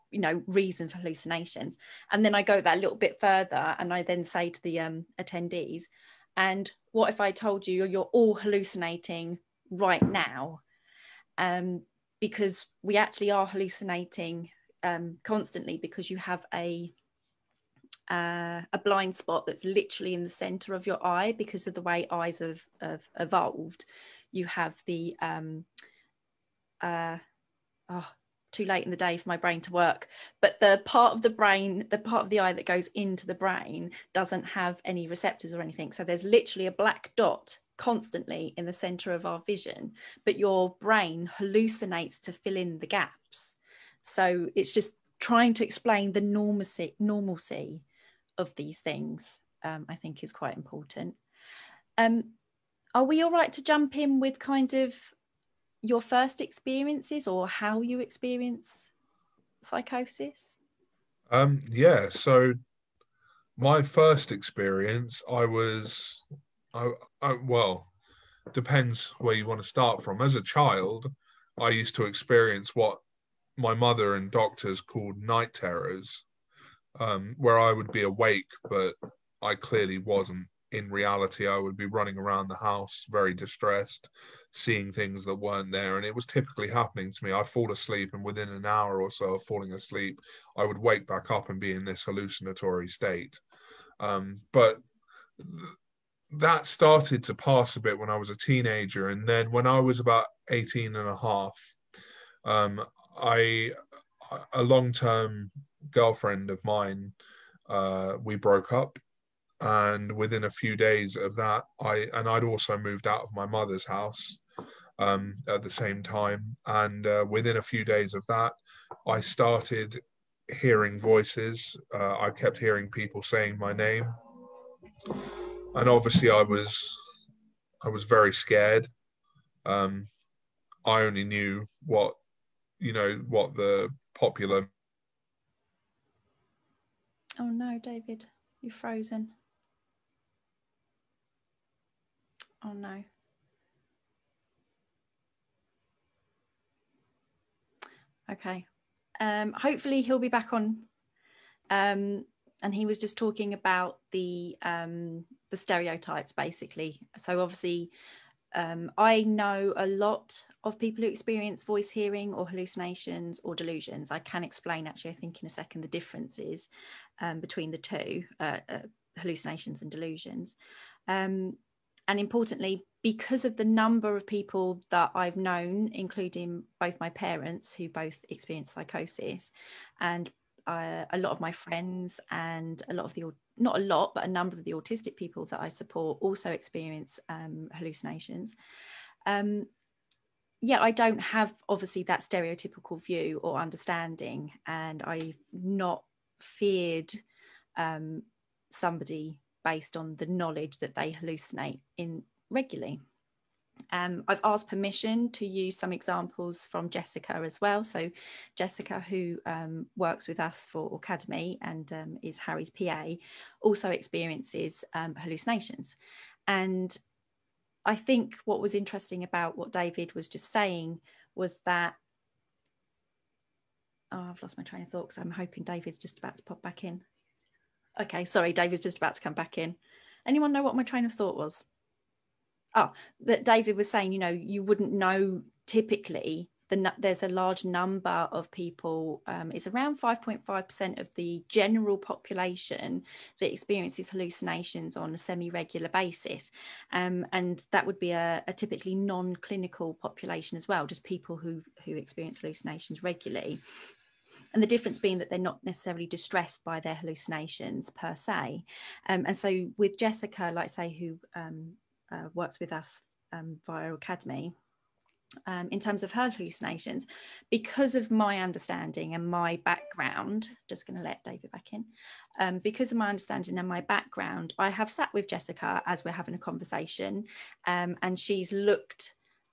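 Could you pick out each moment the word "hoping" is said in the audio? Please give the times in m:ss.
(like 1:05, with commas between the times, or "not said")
3:45.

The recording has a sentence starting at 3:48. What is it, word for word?
Okay, sorry, David's just about to come back in.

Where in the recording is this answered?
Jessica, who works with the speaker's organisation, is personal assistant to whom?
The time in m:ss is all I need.
3:32.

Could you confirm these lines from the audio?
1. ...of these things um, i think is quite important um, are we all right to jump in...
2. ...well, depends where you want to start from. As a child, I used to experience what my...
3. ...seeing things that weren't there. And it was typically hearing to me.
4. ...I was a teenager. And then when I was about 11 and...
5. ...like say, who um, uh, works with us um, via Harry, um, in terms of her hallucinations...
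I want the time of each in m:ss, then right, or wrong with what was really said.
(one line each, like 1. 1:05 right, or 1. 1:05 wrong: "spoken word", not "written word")
1. 0:48 right
2. 1:07 right
3. 1:24 wrong: "happening", not "hearing"
4. 1:38 wrong: "18", not "11"
5. 4:20 wrong: "Aucademy", not "Harry".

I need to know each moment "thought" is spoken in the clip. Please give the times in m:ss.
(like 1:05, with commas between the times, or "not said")
3:44, 3:51.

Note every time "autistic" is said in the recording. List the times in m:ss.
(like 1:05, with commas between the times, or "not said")
3:04.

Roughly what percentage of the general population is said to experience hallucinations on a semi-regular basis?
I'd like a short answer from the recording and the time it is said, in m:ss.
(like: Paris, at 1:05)
5.5%, at 4:00.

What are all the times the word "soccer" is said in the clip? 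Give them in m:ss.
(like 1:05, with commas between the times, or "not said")
not said.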